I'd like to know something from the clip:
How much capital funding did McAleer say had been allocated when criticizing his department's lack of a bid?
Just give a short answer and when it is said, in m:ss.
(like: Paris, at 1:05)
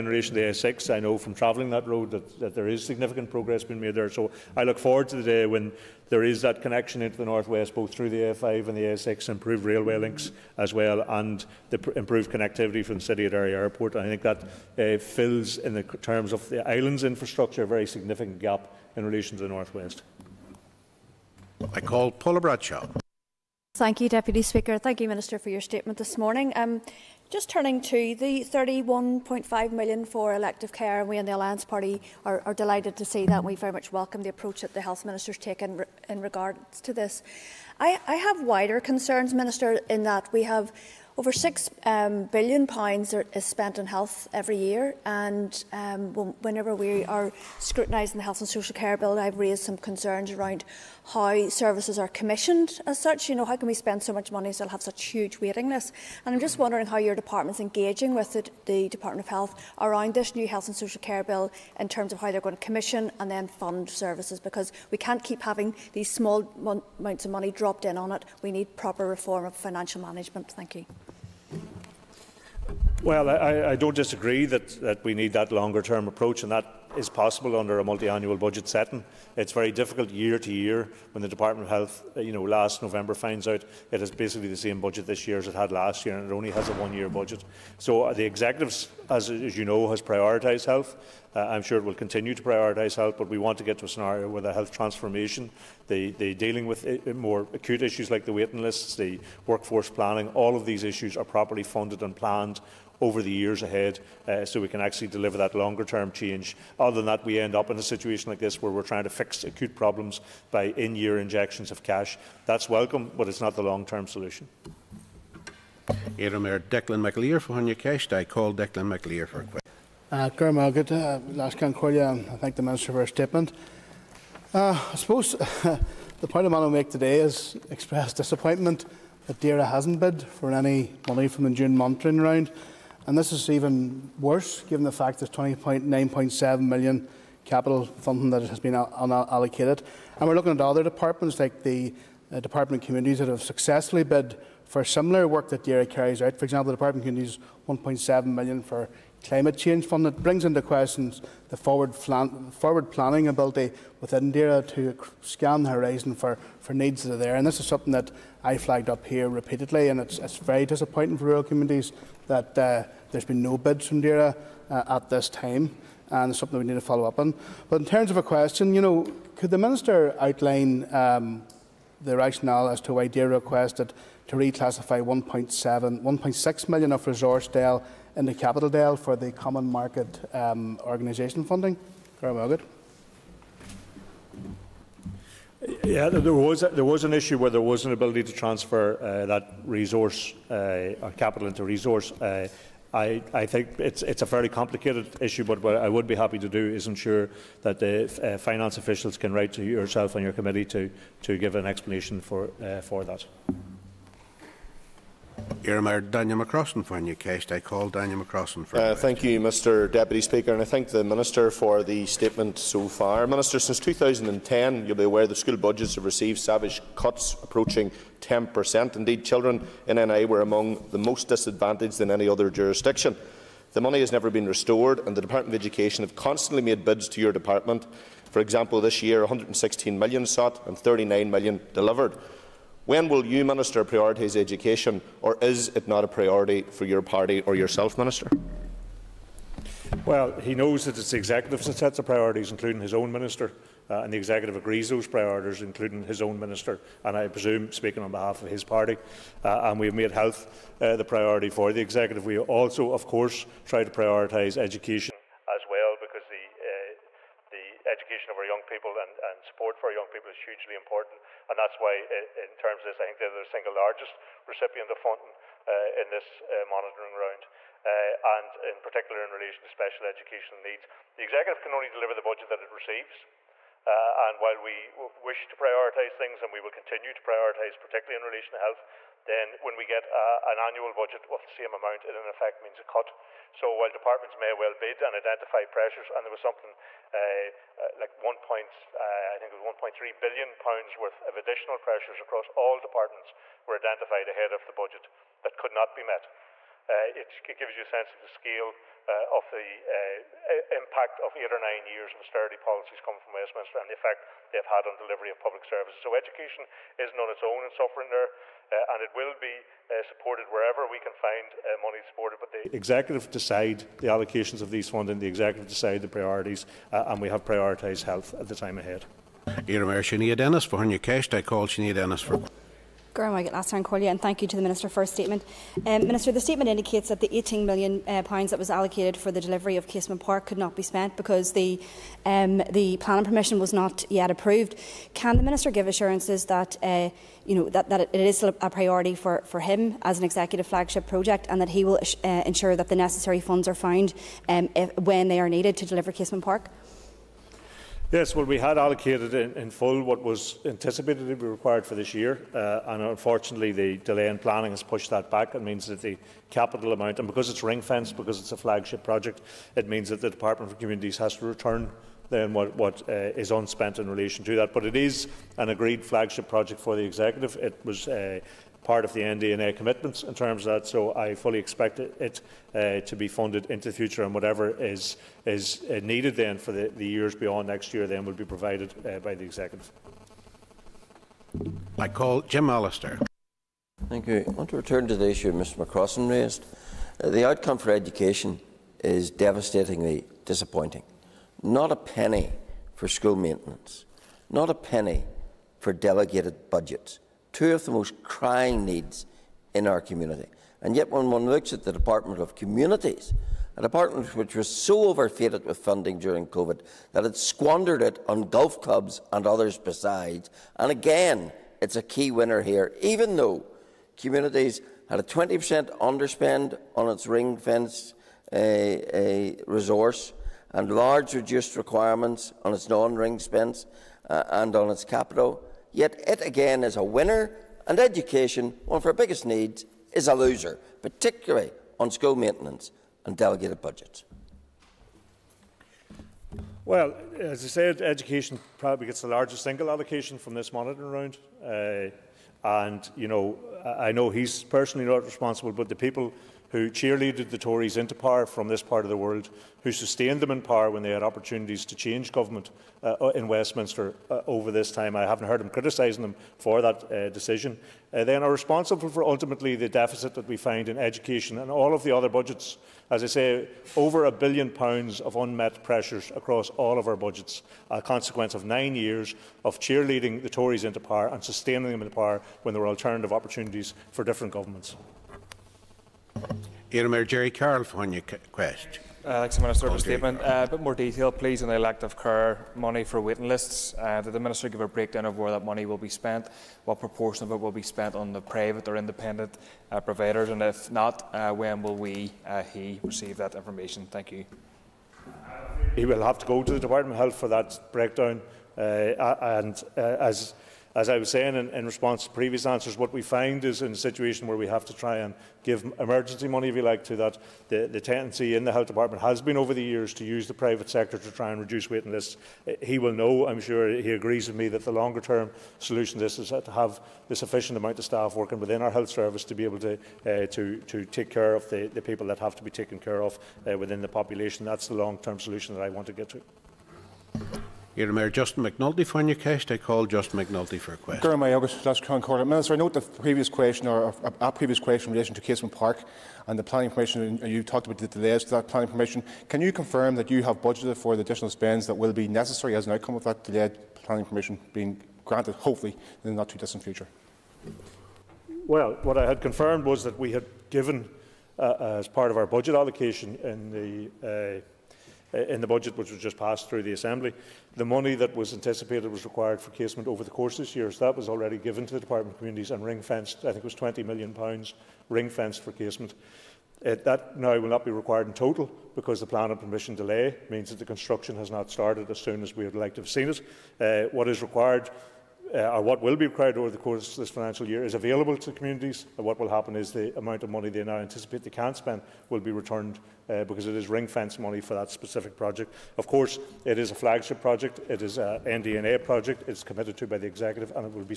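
£29.7 million, at 2:15.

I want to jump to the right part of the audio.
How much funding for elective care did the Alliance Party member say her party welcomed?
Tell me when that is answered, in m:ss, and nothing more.
0:28.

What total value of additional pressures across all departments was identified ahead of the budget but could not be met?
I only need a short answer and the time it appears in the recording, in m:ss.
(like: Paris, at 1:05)
£1.3 billion, at 4:49.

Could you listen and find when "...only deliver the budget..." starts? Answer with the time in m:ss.
4:31.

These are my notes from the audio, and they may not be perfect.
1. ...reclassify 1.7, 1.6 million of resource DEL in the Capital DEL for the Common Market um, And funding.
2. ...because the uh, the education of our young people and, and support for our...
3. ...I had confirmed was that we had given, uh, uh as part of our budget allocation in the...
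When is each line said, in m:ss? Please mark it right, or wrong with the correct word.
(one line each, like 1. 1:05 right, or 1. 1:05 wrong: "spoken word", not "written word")
1. 2:54 wrong: "Organisation", not "And"
2. 4:15 right
3. 9:09 right.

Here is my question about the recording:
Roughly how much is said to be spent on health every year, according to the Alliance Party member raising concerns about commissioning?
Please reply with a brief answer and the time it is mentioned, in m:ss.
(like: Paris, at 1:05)
over £6 billion, at 0:41.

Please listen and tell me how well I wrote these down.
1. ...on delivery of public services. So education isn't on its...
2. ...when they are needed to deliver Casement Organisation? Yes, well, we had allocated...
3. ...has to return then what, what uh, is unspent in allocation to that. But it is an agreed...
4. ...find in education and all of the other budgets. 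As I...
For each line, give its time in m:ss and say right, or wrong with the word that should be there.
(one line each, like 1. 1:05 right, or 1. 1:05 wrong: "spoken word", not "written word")
1. 5:04 right
2. 5:44 wrong: "Park", not "Organisation"
3. 6:01 wrong: "relation", not "allocation"
4. 7:40 right.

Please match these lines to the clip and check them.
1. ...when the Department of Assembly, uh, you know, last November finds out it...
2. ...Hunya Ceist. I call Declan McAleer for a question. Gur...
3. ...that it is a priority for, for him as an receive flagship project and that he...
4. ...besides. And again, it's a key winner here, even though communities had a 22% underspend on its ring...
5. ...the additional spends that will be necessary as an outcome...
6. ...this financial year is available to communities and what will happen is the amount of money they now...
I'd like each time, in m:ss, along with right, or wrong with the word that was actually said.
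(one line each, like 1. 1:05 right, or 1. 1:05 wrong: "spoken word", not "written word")
1. 1:21 wrong: "Health", not "Assembly"
2. 1:57 right
3. 5:37 wrong: "executive", not "receive"
4. 6:49 wrong: "20", not "22"
5. 9:01 right
6. 9:37 right.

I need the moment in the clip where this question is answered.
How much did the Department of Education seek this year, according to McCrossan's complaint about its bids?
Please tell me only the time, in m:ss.
3:49.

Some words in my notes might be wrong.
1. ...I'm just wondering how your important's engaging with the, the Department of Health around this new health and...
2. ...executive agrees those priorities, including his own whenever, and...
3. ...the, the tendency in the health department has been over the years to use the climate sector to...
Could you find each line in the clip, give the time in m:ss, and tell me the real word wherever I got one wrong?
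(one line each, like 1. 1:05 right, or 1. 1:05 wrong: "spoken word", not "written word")
1. 0:56 wrong: "department", not "important"
2. 4:04 wrong: "minister", not "whenever"
3. 8:27 wrong: "private", not "climate".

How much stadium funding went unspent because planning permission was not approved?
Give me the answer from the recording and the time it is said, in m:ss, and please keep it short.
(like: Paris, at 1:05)
£18 million, at 5:27.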